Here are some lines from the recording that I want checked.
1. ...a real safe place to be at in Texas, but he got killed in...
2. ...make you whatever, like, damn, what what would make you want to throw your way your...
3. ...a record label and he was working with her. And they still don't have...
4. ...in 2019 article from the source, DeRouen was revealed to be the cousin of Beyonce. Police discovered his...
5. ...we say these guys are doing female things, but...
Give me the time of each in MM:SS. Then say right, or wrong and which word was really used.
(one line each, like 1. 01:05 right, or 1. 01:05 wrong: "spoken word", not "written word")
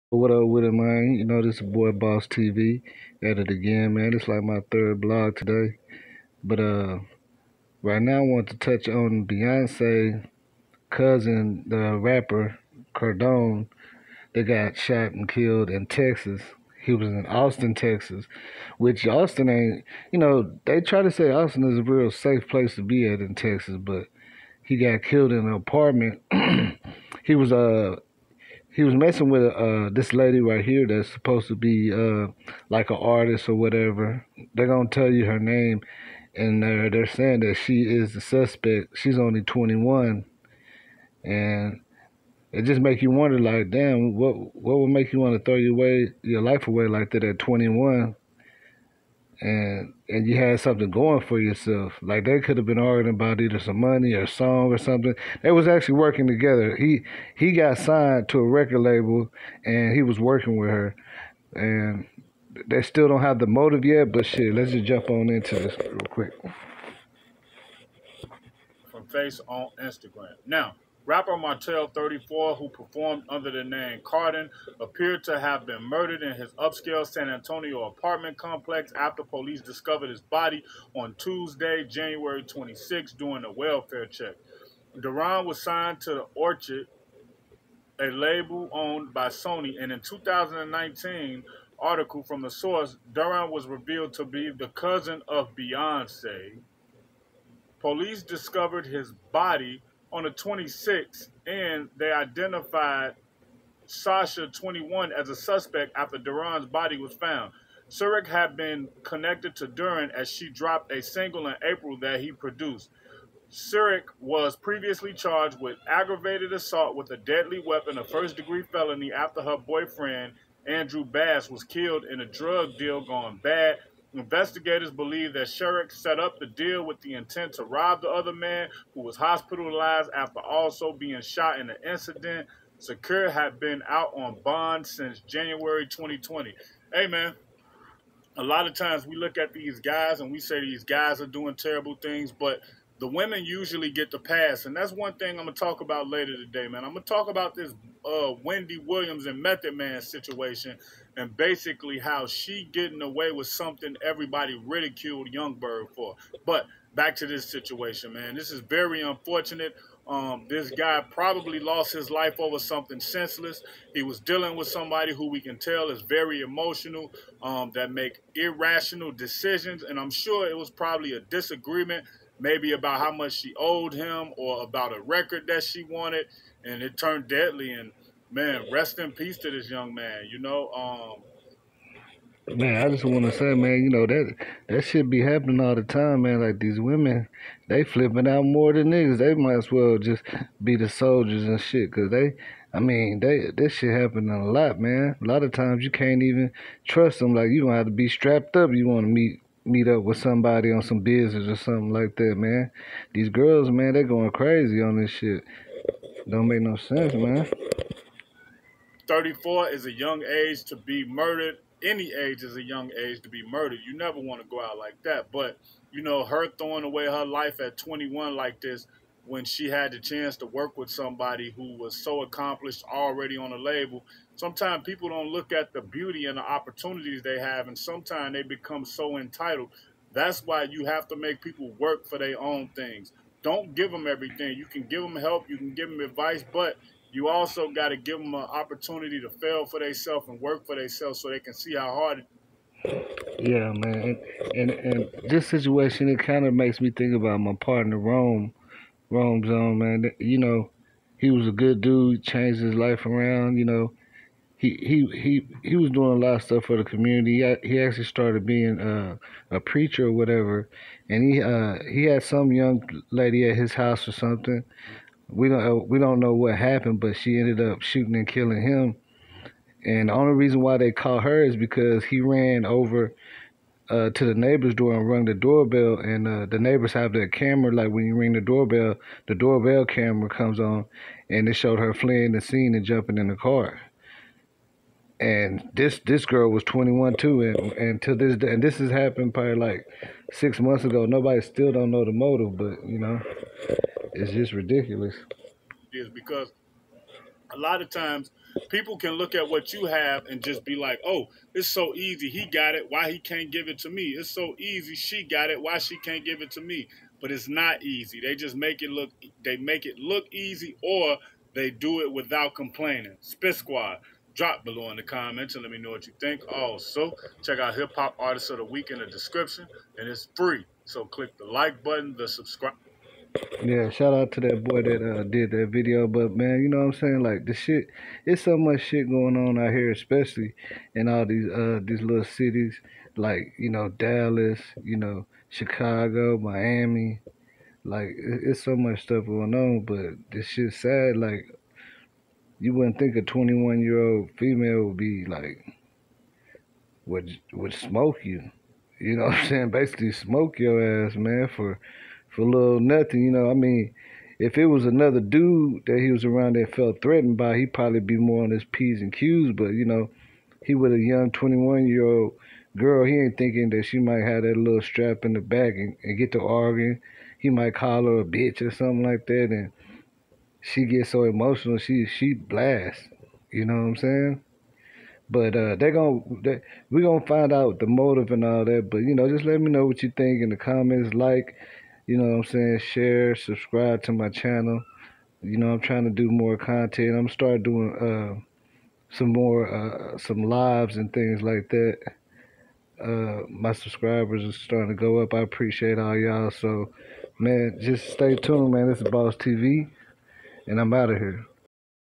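1. 00:21 right
2. 00:42 wrong: "wonder", not "whatever"
3. 00:58 right
4. 01:29 right
5. 02:20 wrong: "terrible", not "female".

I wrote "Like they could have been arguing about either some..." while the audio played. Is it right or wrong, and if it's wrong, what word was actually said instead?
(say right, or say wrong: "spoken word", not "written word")
right.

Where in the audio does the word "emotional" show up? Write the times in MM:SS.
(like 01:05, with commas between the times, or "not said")
02:46, 06:11.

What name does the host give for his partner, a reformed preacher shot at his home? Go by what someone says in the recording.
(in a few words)
Rome Zone.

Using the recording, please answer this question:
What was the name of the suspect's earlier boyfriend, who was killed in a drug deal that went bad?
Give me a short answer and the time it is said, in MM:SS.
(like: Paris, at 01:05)
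Andrew Bass, at 02:00.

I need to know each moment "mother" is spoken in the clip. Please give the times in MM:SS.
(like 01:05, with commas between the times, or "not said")
not said.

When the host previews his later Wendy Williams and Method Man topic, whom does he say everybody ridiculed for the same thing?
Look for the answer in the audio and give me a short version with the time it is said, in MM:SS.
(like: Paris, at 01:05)
Yung Berg, at 02:35.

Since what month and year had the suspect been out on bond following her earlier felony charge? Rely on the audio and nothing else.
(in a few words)
January 2020.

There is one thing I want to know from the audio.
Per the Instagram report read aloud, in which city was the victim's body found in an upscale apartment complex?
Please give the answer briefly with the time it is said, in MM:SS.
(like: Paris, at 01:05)
San Antonio, at 01:17.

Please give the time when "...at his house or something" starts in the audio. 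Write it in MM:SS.
04:23.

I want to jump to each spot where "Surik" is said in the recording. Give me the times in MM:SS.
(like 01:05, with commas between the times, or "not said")
01:47, 01:53.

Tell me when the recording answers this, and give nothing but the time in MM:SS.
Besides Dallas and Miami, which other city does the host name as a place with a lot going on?
05:35.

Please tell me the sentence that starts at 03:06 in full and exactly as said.
Like these women, they flipping out more than niggas.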